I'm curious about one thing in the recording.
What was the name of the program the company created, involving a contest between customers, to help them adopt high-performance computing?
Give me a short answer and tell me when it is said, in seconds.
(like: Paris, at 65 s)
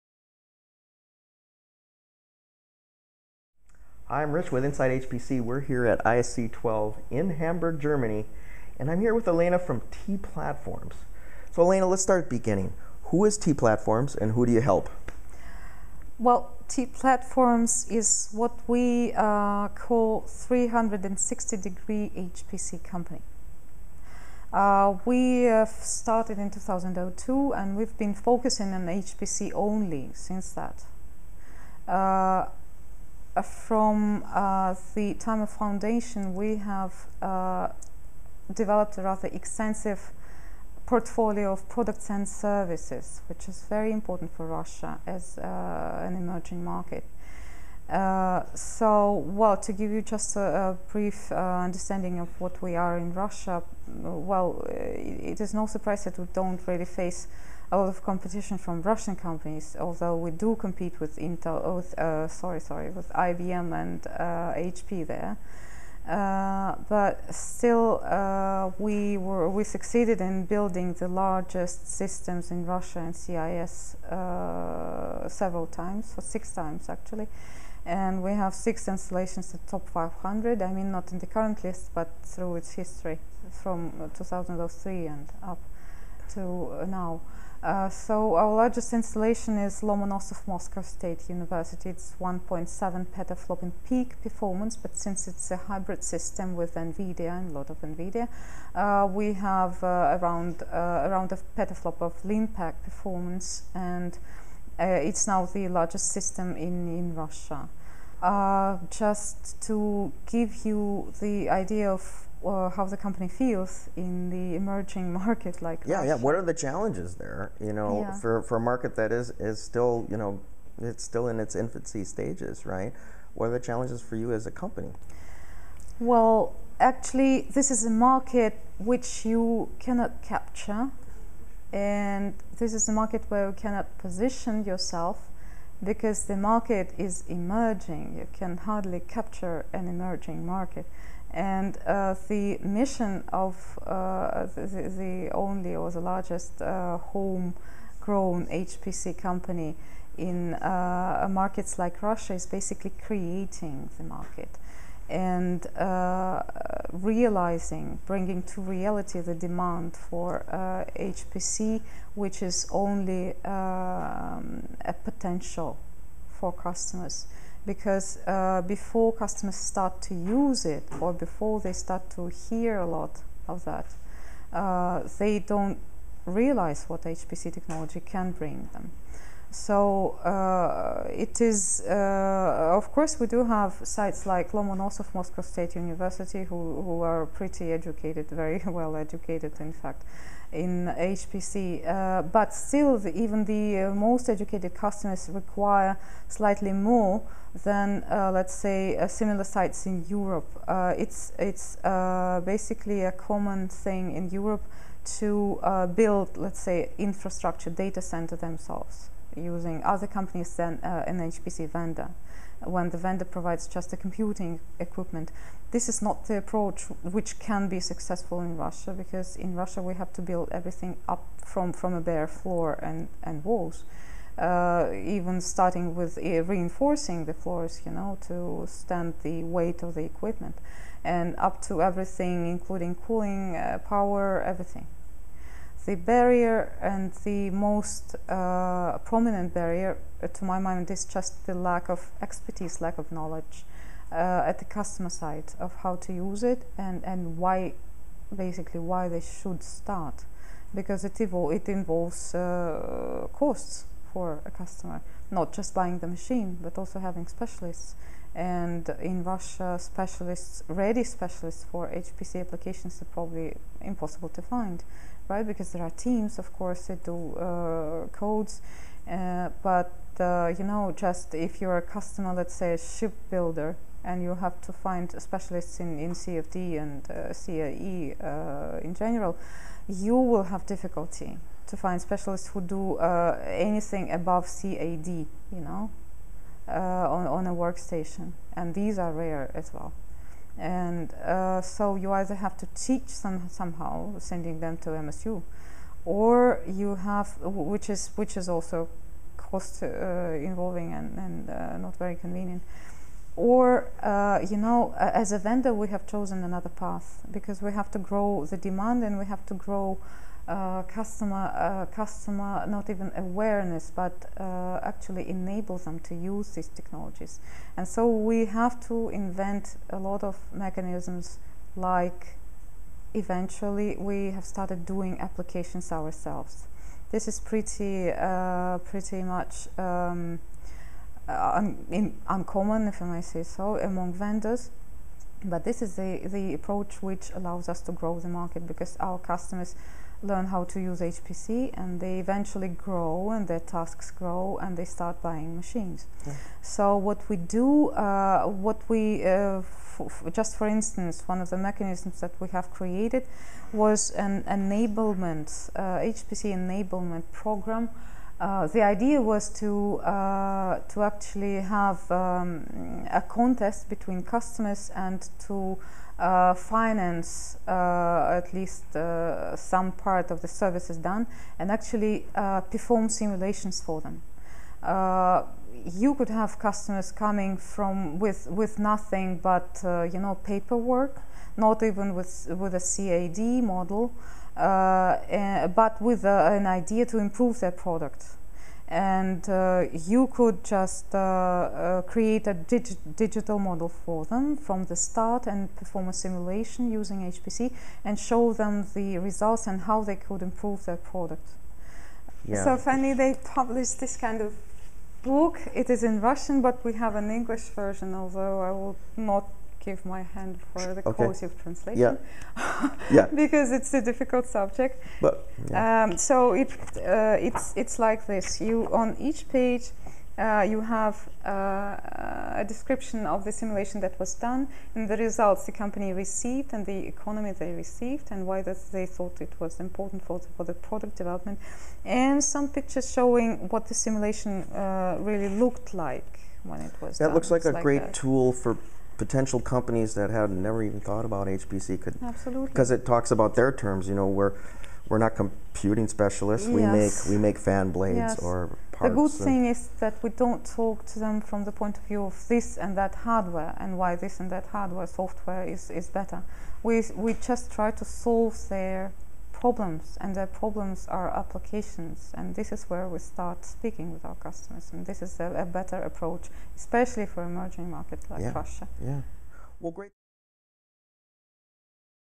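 HPC enablement program, at 356 s.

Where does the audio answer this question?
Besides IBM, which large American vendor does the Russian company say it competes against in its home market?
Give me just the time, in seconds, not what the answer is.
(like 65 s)
64 s.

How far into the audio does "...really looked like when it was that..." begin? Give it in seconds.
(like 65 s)
435 s.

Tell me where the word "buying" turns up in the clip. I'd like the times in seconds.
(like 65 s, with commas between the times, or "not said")
255 s, 345 s.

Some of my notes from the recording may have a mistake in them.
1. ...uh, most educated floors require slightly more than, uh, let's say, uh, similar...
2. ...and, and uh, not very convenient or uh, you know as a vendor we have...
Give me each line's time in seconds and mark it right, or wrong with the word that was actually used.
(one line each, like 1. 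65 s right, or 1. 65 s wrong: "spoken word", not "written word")
1. 193 s wrong: "customers", not "floors"
2. 300 s right.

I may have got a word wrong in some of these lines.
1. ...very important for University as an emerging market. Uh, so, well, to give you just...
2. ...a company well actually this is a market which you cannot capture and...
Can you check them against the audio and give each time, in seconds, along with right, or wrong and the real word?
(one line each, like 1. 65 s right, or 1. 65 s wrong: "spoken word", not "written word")
1. 43 s wrong: "Russia", not "University"
2. 124 s right.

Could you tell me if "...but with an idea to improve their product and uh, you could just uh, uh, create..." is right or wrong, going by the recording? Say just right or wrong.
right.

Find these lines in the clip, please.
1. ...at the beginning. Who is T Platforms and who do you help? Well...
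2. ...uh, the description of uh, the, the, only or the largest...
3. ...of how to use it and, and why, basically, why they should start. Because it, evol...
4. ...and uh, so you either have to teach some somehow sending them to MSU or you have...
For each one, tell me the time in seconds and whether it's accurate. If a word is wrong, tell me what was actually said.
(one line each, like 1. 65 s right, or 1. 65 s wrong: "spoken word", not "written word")
1. 12 s right
2. 141 s wrong: "mission", not "description"
3. 245 s right
4. 290 s right.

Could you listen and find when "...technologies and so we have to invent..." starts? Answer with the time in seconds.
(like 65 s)
316 s.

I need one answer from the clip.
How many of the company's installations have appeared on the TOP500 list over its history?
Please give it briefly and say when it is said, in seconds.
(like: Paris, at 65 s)
6, at 78 s.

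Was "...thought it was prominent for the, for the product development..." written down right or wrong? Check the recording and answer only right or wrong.
wrong.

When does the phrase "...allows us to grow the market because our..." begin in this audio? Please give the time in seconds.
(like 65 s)
337 s.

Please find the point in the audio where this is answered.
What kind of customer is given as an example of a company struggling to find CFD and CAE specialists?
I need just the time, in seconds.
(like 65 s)
272 s.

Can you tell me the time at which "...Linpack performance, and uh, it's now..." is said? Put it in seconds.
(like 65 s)
102 s.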